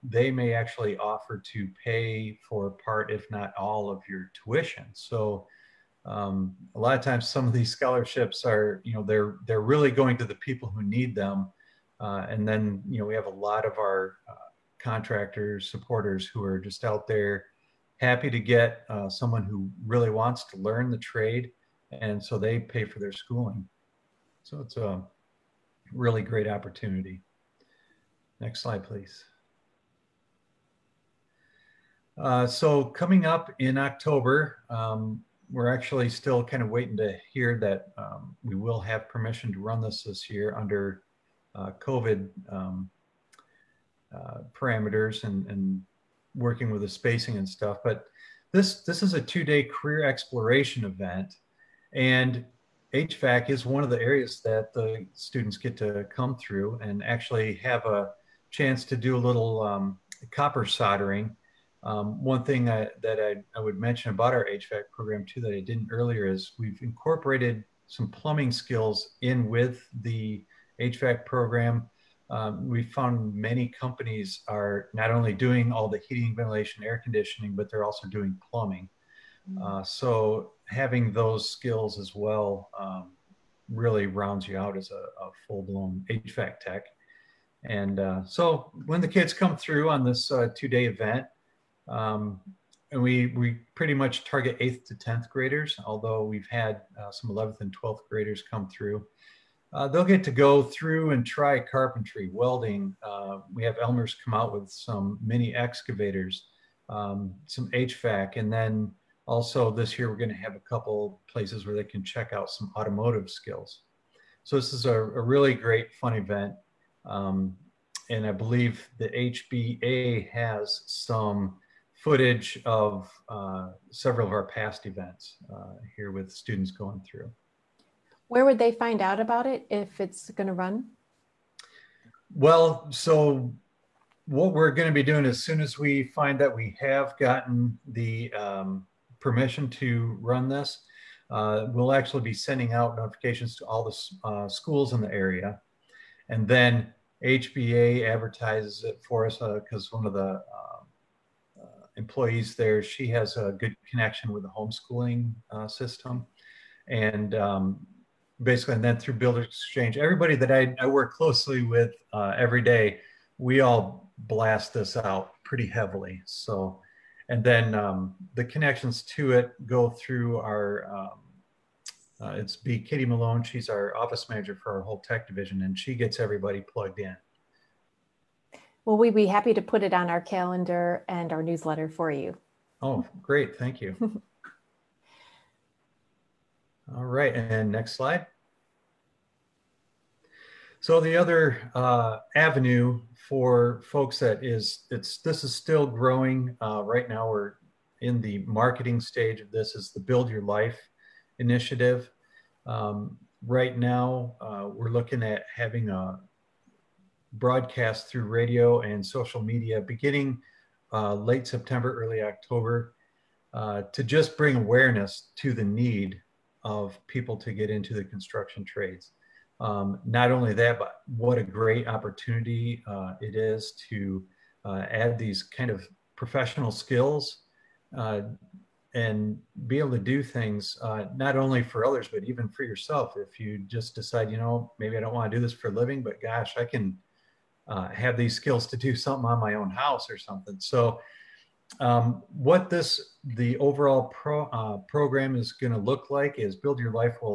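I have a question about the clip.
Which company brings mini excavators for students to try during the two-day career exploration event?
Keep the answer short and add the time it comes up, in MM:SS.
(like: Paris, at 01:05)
Elmer's, at 01:43.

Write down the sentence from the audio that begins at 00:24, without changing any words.
So it's a really great opportunity.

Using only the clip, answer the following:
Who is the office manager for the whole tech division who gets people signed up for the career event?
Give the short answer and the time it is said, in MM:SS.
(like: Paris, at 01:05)
Katie Malone, at 02:52.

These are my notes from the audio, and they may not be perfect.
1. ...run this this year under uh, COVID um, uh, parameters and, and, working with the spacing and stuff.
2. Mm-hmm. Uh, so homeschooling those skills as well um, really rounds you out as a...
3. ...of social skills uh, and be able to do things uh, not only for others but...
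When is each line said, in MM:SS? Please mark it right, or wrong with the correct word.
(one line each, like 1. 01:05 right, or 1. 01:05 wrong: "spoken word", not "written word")
1. 00:39 right
2. 01:19 wrong: "having", not "homeschooling"
3. 03:45 wrong: "professional", not "social".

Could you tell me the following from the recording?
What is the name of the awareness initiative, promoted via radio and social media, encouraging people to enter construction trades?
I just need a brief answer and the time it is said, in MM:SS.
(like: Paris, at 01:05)
Build Your Life, at 03:19.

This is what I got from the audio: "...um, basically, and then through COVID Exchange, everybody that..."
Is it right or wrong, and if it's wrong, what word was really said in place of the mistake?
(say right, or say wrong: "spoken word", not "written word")
wrong: "Builder", not "COVID".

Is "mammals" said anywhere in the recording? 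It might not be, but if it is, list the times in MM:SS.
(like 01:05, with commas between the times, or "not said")
not said.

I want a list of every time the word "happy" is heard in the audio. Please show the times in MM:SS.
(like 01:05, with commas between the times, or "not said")
00:17, 02:59.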